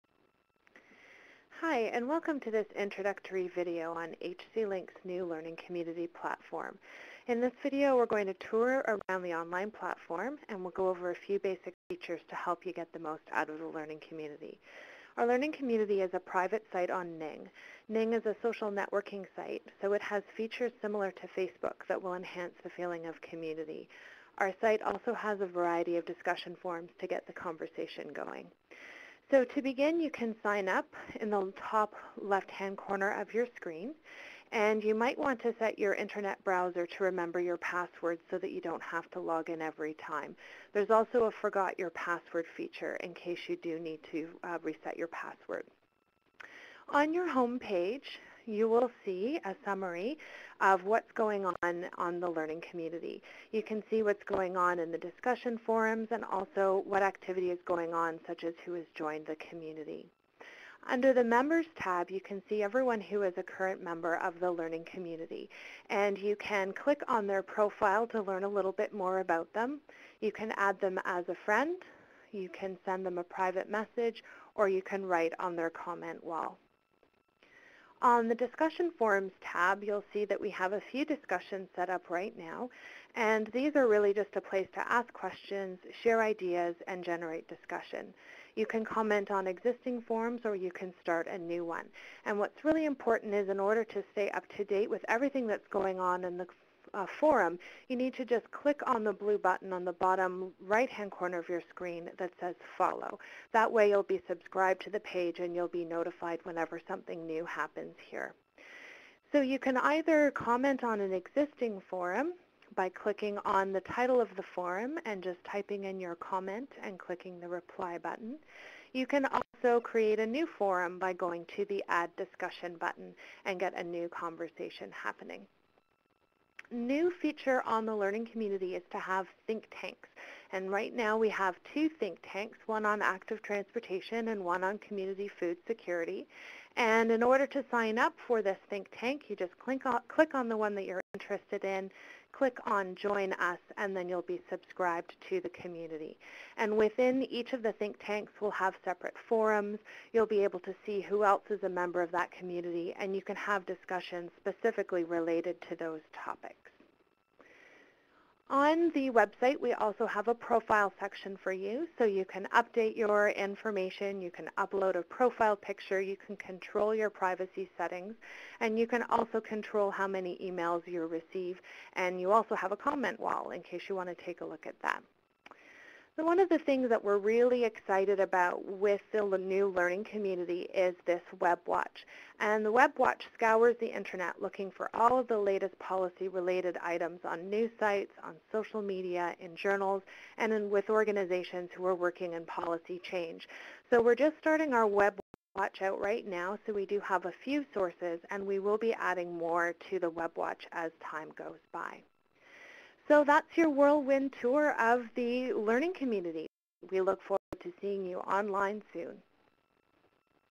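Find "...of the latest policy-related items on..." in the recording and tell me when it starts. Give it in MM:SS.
03:05.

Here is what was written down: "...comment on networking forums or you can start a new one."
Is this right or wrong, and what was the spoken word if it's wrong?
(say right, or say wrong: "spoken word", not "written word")
wrong: "existing", not "networking".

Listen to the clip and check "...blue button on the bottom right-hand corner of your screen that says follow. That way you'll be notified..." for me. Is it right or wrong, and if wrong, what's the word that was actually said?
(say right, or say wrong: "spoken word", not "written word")
wrong: "subscribed", not "notified".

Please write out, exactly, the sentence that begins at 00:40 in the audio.
There's also a forgot your password feature in case you do need to uh, reset your password.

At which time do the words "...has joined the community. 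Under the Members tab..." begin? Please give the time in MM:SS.
00:58.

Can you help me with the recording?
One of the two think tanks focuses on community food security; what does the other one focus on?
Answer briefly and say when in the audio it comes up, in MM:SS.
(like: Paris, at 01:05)
Active transportation, at 02:13.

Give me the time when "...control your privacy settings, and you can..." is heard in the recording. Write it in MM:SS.
02:46.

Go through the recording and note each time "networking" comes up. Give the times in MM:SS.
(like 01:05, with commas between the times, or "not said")
00:18.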